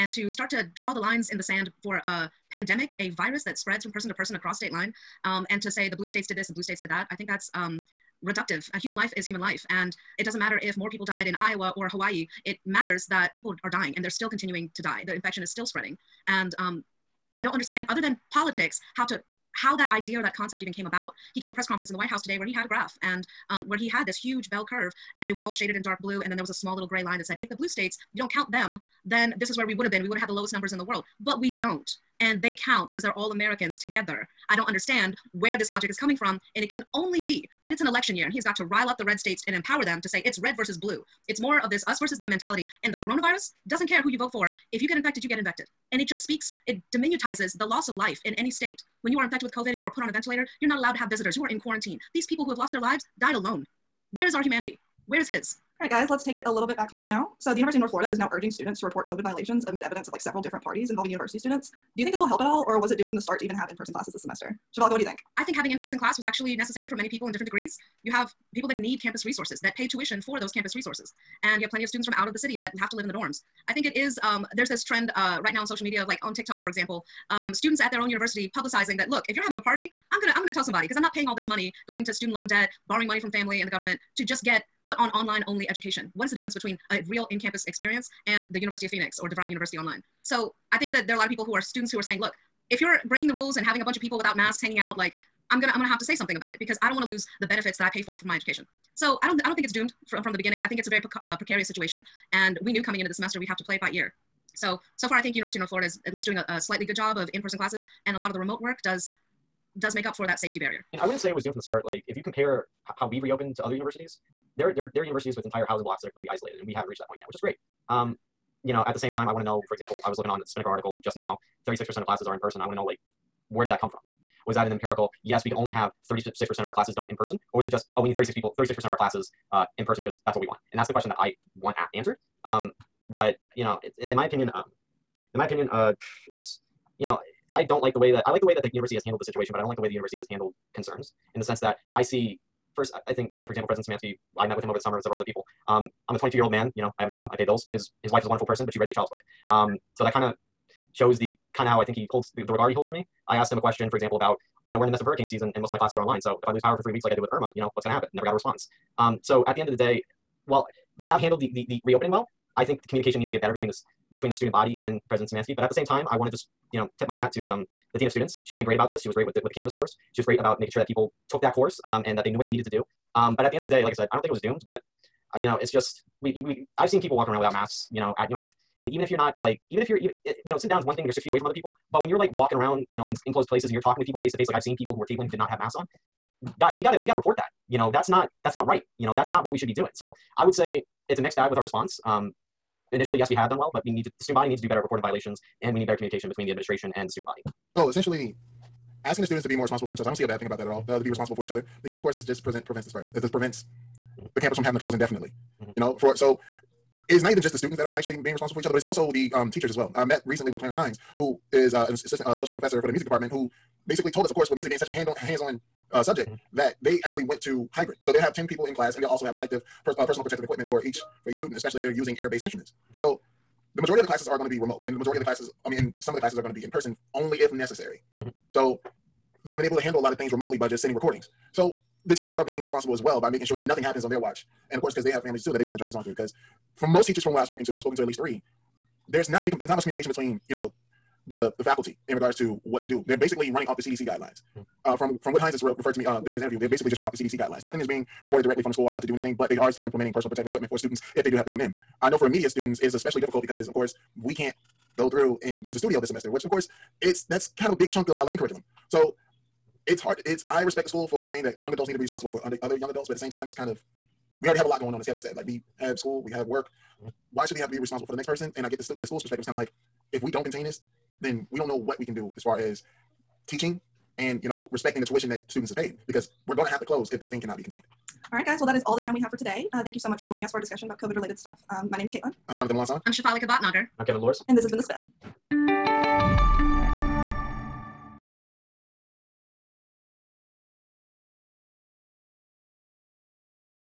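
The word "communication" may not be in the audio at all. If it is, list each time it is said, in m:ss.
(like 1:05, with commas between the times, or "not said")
2:42, 3:15, 3:59.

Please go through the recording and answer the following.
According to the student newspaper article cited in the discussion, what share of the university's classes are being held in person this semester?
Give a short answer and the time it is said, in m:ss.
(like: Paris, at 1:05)
36%, at 2:01.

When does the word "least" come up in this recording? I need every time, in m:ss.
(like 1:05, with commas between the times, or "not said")
1:46, 3:58.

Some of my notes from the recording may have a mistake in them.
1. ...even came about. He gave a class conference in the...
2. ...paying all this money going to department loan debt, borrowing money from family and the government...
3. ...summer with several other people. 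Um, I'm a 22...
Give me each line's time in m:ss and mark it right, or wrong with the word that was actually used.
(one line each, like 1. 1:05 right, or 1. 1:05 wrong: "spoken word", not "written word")
1. 0:20 wrong: "press", not "class"
2. 1:21 wrong: "student", not "department"
3. 2:24 right.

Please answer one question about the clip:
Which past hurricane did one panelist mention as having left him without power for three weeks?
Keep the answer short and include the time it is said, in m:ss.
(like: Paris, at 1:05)
Irma, at 2:37.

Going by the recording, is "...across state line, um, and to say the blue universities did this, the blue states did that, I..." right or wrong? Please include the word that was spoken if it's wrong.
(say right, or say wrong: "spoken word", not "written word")
wrong: "states", not "universities".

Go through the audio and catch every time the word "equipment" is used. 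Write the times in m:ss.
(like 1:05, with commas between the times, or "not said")
3:40, 4:10.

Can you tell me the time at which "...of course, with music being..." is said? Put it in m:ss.
3:34.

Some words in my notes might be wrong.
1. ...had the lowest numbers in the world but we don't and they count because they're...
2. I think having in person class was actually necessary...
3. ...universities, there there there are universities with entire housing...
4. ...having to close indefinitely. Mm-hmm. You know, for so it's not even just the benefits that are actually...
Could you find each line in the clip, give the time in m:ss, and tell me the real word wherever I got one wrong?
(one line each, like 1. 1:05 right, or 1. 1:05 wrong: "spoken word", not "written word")
1. 0:30 right
2. 1:05 right
3. 1:53 right
4. 3:24 wrong: "students", not "benefits".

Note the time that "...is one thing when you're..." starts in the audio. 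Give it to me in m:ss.
3:00.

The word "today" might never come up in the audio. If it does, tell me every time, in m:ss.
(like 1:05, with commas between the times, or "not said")
0:22, 4:39.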